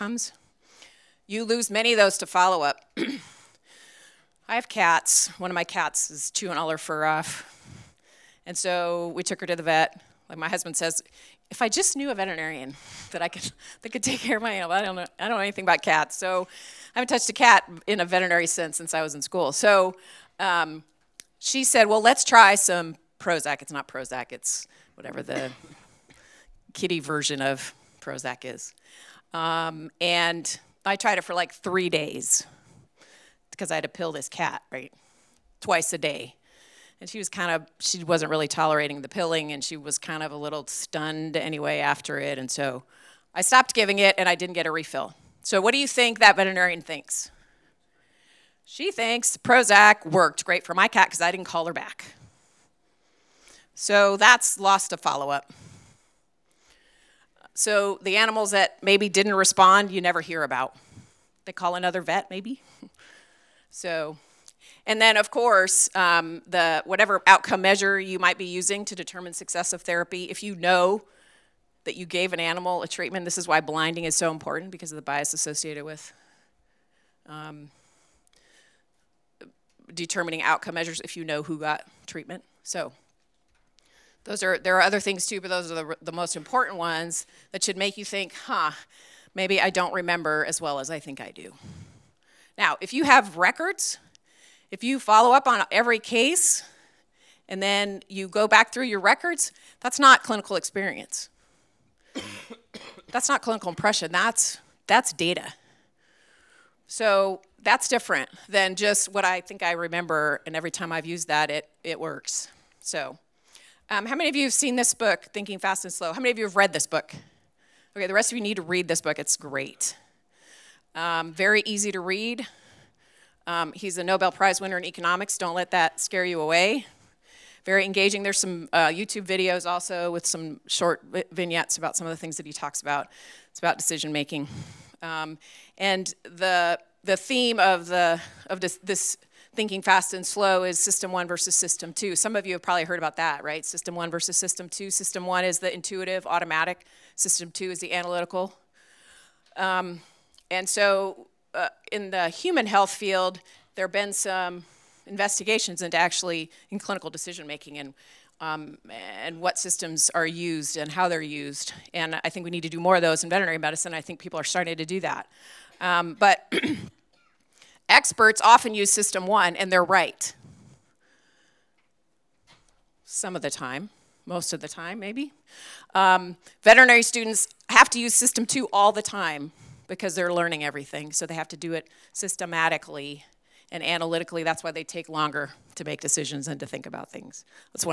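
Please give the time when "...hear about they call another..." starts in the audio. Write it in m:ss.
1:00.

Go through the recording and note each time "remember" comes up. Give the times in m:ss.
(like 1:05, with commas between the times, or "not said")
1:29, 1:49.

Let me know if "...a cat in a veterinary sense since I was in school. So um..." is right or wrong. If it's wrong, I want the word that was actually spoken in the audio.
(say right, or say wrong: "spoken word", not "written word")
right.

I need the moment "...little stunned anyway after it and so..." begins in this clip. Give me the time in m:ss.
0:40.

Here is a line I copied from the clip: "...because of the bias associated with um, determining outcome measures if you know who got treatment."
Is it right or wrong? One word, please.
right.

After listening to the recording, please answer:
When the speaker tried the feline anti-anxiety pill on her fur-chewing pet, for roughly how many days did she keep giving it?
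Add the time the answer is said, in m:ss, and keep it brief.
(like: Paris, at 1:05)
3 days, at 0:31.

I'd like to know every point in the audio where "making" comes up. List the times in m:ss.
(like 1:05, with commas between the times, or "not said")
2:14, 2:37.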